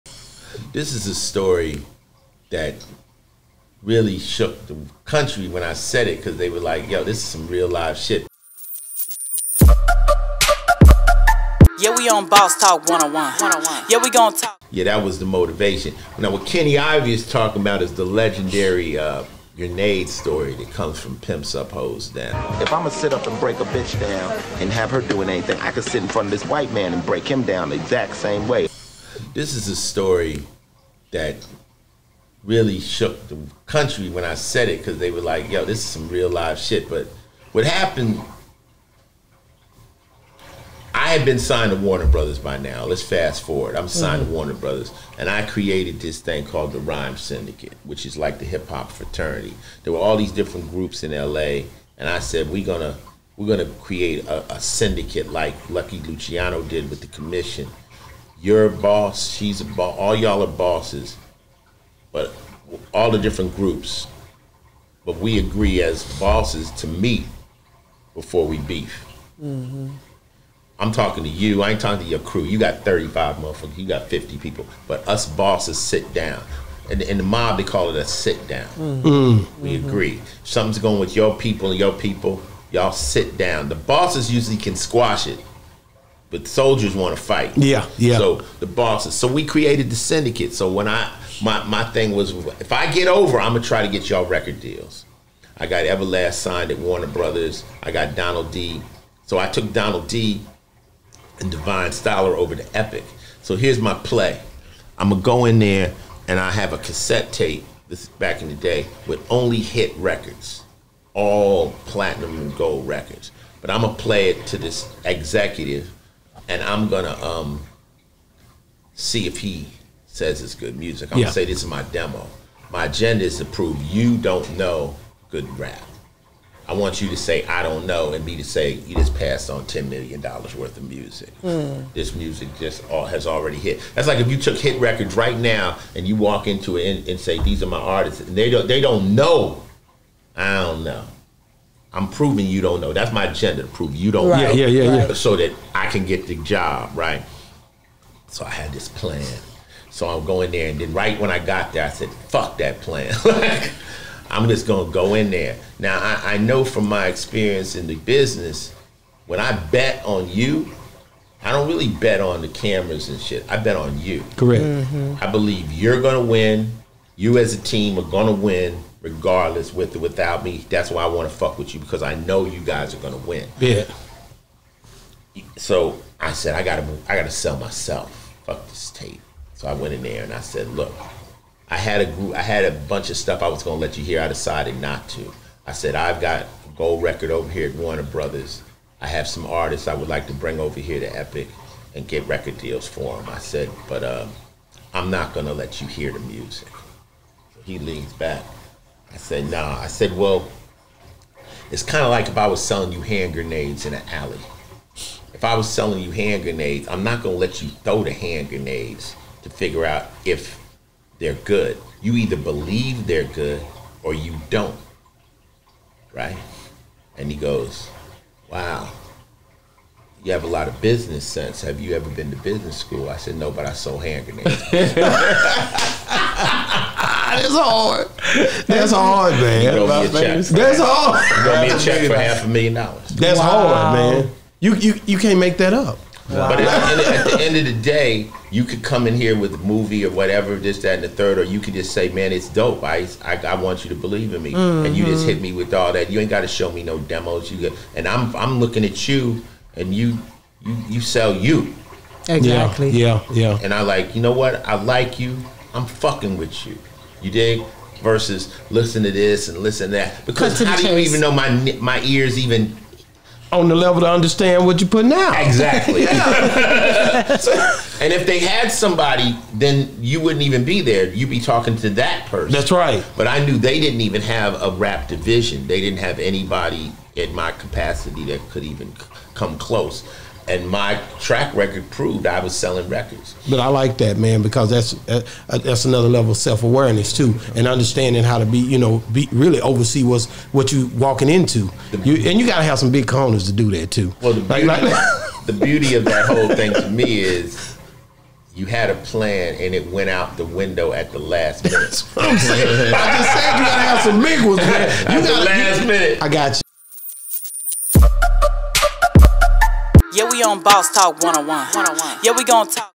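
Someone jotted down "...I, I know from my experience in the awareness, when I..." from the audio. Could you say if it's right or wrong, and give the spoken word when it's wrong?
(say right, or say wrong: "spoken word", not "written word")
wrong: "business", not "awareness".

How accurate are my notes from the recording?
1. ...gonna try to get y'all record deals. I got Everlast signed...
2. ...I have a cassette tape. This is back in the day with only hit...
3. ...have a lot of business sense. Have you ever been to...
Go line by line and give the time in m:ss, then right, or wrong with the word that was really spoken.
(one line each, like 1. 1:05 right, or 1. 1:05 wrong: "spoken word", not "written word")
1. 1:33 right
2. 1:46 right
3. 3:40 right.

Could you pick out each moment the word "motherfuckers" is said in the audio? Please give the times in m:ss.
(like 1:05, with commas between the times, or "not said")
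1:13.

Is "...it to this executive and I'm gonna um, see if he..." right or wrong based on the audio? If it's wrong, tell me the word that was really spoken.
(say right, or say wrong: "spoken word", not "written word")
right.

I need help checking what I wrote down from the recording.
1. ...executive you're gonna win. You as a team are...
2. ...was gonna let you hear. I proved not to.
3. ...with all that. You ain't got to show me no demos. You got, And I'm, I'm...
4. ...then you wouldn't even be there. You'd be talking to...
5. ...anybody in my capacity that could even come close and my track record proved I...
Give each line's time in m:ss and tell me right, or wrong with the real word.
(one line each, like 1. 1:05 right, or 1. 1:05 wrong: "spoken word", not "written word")
1. 2:45 wrong: "believe", not "executive"
2. 3:03 wrong: "decided", not "proved"
3. 4:05 right
4. 4:29 right
5. 4:36 right.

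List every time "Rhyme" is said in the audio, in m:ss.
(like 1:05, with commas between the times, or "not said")
0:46.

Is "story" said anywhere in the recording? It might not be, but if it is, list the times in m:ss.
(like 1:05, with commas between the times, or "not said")
0:01, 0:20, 0:29.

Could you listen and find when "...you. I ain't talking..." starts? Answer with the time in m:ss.
1:11.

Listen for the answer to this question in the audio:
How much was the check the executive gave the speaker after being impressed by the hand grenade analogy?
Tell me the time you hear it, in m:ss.
3:52.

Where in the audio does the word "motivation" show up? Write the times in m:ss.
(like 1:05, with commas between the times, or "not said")
0:15.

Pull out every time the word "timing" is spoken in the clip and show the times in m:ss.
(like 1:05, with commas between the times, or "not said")
not said.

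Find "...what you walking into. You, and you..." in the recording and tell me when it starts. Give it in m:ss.
4:50.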